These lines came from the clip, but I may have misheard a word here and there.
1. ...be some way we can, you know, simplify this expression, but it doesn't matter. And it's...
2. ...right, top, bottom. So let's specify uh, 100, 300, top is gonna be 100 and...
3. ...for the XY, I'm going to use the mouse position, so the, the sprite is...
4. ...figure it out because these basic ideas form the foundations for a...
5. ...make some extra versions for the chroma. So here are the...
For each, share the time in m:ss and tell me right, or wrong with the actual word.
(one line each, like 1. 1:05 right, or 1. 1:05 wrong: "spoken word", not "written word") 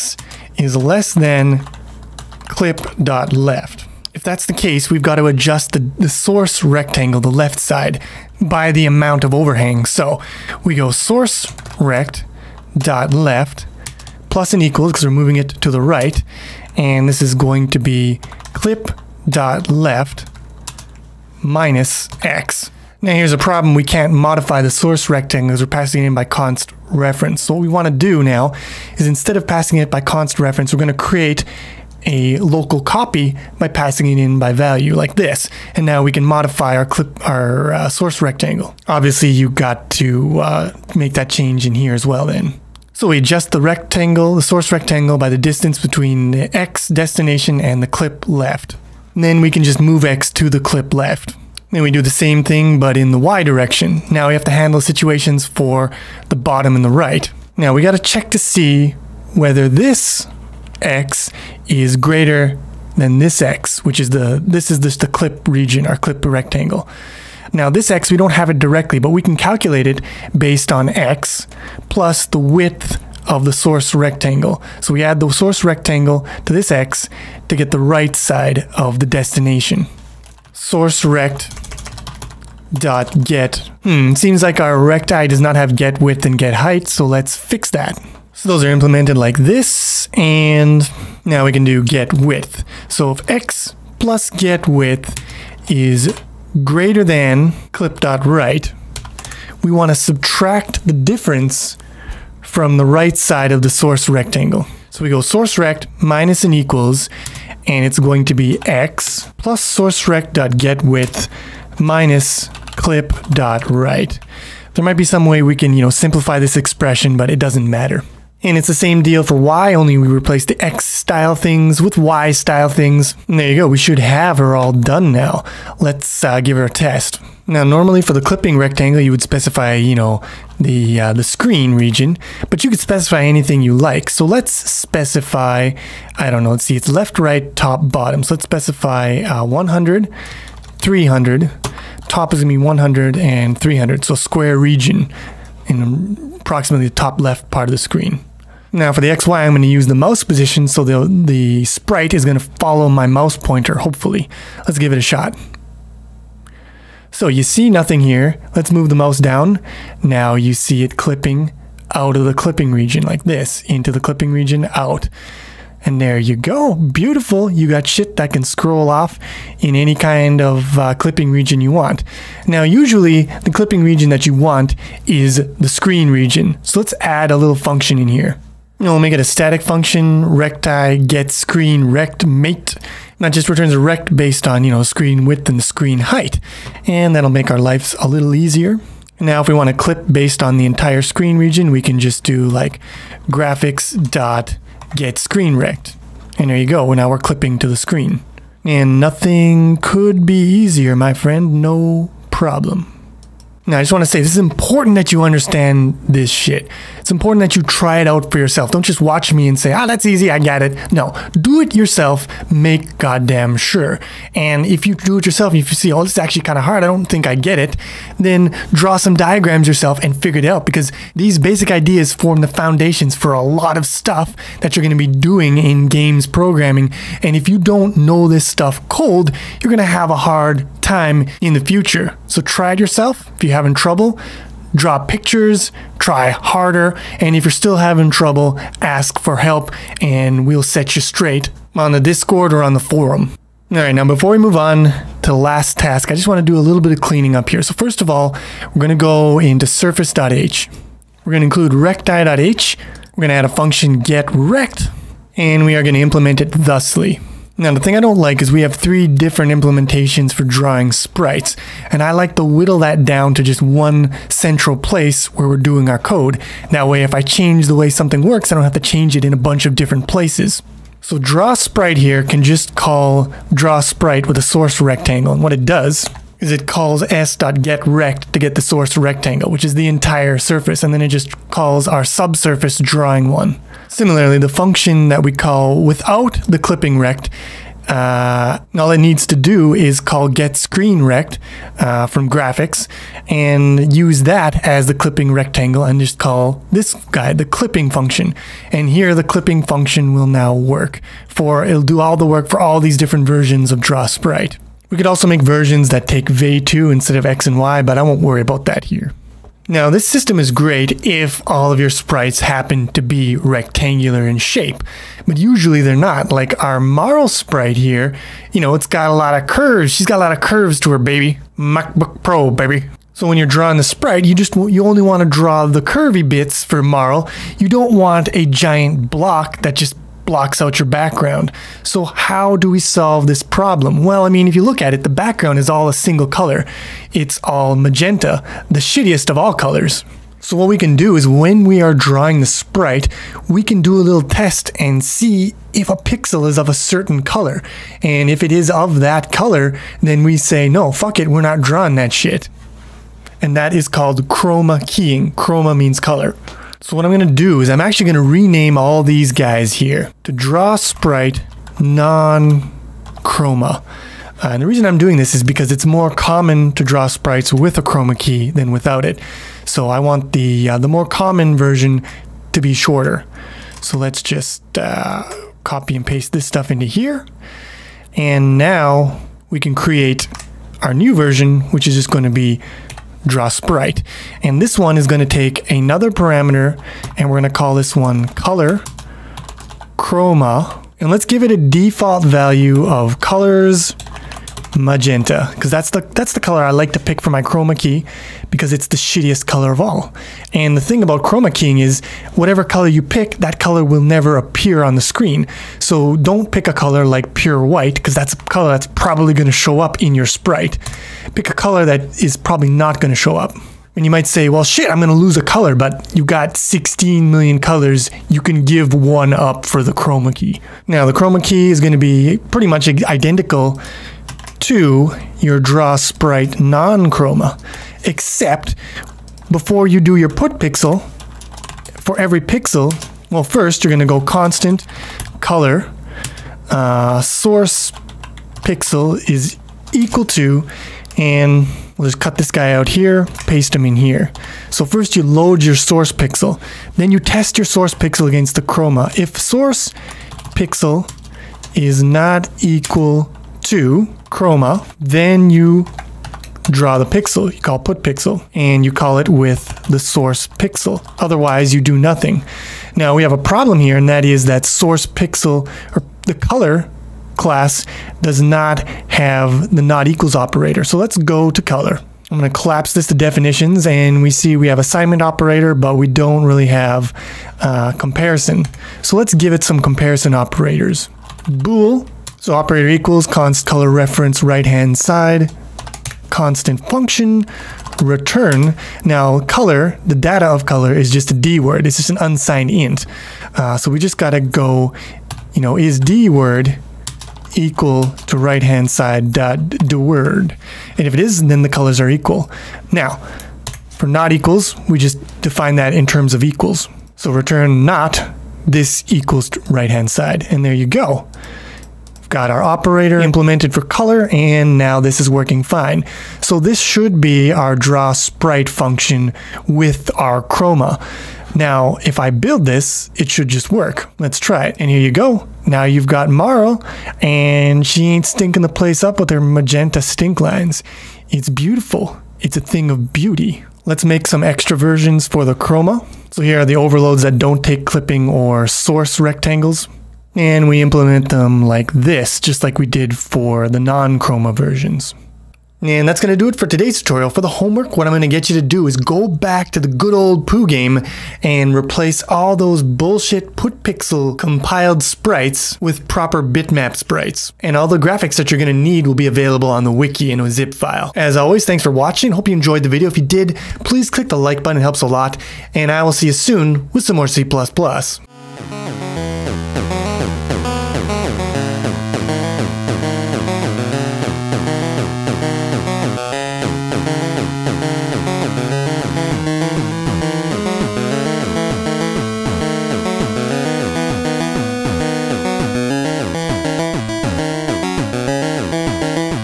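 1. 1:55 right
2. 2:17 right
3. 2:28 right
4. 3:40 right
5. 8:54 right.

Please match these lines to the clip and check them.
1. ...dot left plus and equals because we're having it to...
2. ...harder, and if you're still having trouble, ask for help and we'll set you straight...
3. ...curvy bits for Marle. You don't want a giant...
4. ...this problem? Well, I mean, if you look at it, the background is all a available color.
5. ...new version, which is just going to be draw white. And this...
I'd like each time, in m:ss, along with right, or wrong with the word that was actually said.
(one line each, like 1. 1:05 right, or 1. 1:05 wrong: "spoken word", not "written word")
1. 0:12 wrong: "moving", not "having"
2. 3:56 right
3. 5:25 right
4. 5:33 wrong: "single", not "available"
5. 6:20 wrong: "sprite", not "white".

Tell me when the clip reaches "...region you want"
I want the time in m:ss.
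2:51.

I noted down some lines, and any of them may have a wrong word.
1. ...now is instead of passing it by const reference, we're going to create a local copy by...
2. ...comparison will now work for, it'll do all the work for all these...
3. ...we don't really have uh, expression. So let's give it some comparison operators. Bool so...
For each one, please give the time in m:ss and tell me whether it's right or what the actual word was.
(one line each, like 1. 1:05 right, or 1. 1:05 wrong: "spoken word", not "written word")
1. 0:28 right
2. 4:59 wrong: "function", not "comparison"
3. 7:55 wrong: "comparison", not "expression".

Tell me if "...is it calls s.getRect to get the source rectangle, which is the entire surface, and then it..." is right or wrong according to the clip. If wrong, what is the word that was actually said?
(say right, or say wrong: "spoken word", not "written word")
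right.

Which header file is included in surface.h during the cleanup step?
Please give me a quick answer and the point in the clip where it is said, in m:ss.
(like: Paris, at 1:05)
recti.h, at 4:11.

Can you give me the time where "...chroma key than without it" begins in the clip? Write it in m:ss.
6:07.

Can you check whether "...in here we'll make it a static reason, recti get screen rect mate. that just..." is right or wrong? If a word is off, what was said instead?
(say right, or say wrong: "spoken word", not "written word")
wrong: "function", not "reason".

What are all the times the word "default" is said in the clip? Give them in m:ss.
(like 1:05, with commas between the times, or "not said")
6:31.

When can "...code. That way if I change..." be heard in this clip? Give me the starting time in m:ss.
4:25.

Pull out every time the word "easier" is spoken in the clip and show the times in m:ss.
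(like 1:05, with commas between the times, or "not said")
3:08, 3:20.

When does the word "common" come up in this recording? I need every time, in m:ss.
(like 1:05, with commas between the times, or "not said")
6:06, 6:11.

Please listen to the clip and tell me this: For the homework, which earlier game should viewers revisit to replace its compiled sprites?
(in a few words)
Poo game.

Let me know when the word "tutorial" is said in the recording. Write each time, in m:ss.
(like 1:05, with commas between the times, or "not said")
9:07.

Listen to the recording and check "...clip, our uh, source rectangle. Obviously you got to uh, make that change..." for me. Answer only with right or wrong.
right.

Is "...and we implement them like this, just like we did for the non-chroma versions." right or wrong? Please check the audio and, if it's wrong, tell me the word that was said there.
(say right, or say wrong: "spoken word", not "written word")
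right.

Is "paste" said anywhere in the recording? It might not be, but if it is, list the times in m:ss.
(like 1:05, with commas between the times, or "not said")
6:16, 7:23.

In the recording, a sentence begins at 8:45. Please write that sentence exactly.
Now you've got Marle, and she ain't stinking the place up with her magenta stink lines.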